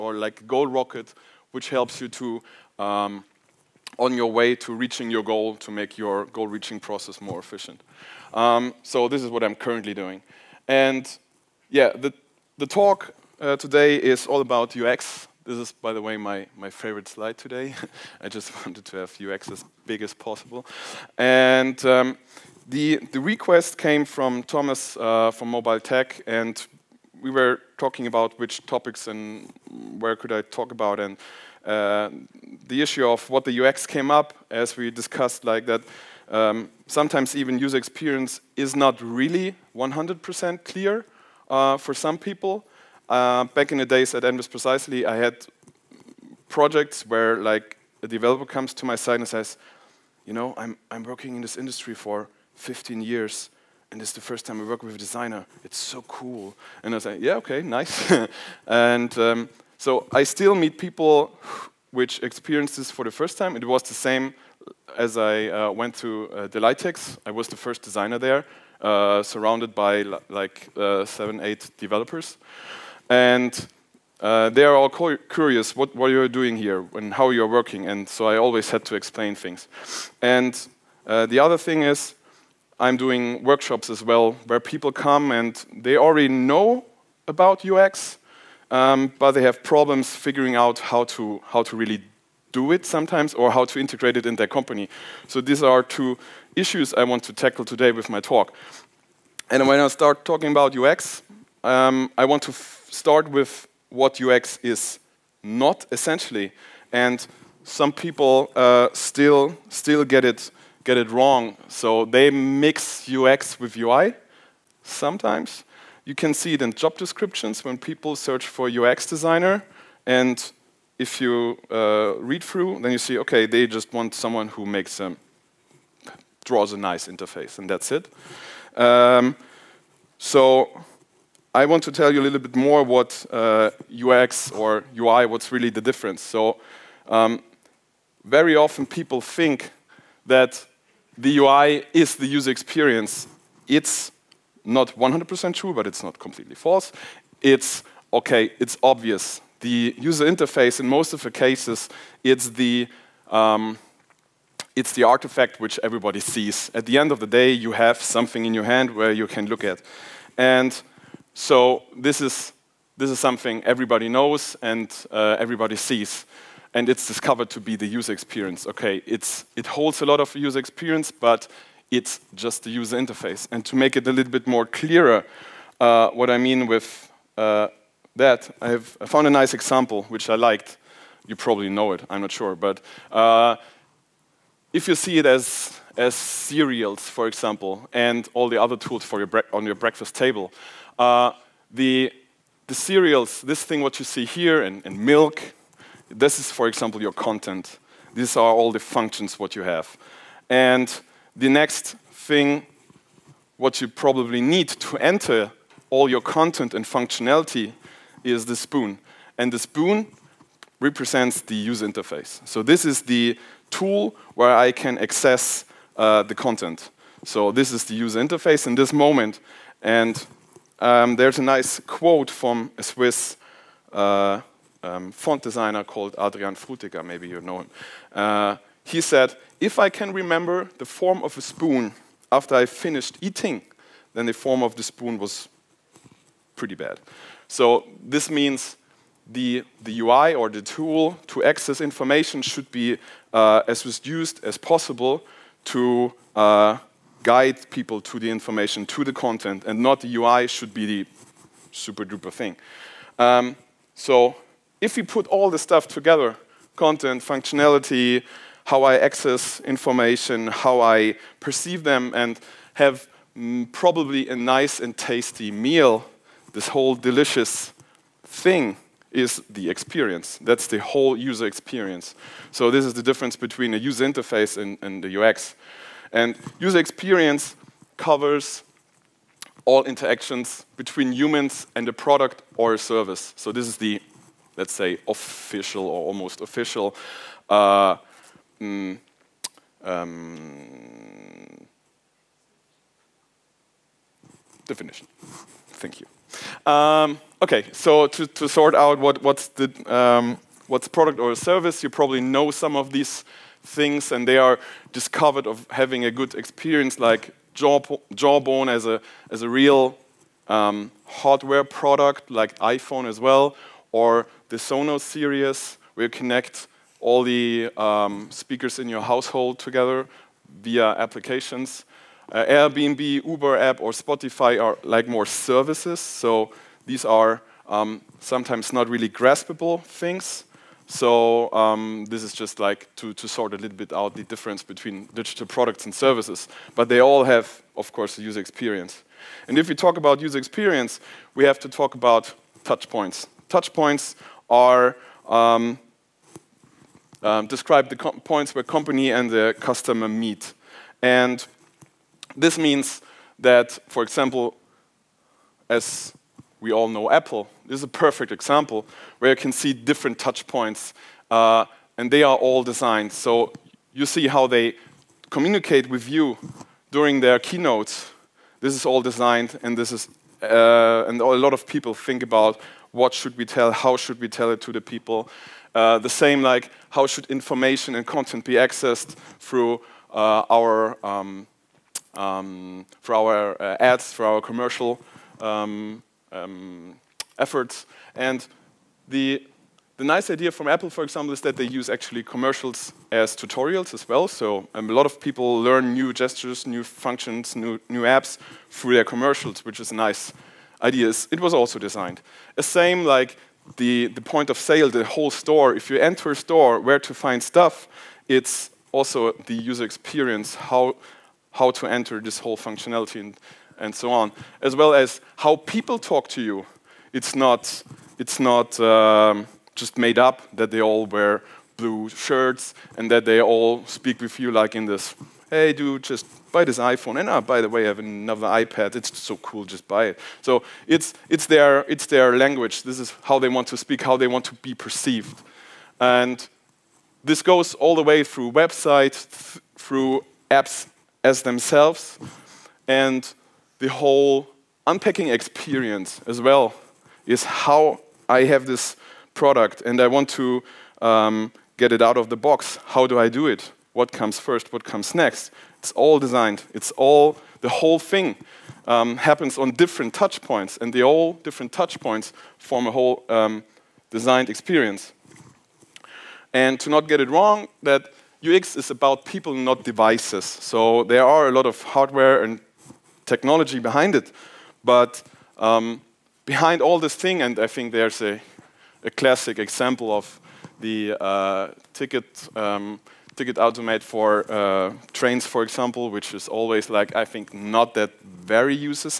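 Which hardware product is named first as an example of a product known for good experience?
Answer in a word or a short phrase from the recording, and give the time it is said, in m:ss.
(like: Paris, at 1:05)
Jawbone, at 5:07.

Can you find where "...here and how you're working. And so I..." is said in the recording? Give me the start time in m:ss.
1:16.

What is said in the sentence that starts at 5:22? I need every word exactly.
Uh, Airbnb, Uber app, or Spotify are like more services.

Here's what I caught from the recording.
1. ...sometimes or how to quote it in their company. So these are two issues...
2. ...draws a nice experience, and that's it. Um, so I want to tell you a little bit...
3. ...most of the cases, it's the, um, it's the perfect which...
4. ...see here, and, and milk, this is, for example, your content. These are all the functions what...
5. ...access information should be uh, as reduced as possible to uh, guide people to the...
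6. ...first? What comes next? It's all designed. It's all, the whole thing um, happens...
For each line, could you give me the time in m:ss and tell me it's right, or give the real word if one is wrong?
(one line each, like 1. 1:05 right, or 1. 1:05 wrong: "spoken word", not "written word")
1. 1:32 wrong: "integrate", not "quote"
2. 2:06 wrong: "interface", not "experience"
3. 2:30 wrong: "artifact", not "perfect"
4. 3:14 right
5. 4:01 right
6. 7:34 right.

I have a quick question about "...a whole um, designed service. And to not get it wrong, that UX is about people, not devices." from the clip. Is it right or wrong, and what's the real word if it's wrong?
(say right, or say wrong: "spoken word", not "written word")
wrong: "experience", not "service".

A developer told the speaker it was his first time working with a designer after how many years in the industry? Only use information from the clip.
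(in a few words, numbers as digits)
15.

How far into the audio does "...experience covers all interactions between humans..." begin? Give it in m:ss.
4:36.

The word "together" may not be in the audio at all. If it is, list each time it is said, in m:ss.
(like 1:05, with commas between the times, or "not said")
4:15, 5:19.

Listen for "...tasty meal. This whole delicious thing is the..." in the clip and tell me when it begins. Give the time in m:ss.
4:24.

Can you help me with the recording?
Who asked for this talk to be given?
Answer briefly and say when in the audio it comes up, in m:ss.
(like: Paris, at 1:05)
Thomas, at 0:24.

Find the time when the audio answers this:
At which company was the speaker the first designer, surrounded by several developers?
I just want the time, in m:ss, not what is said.
1:06.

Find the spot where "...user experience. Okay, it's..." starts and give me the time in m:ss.
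2:47.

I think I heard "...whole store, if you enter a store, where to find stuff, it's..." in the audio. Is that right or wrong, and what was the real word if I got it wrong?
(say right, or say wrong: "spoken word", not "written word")
right.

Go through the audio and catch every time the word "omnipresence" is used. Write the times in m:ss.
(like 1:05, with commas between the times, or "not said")
not said.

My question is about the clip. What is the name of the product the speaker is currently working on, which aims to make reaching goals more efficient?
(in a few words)
Goal Rocket.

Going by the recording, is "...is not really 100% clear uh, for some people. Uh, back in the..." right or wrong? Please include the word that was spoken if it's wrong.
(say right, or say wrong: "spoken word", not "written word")
right.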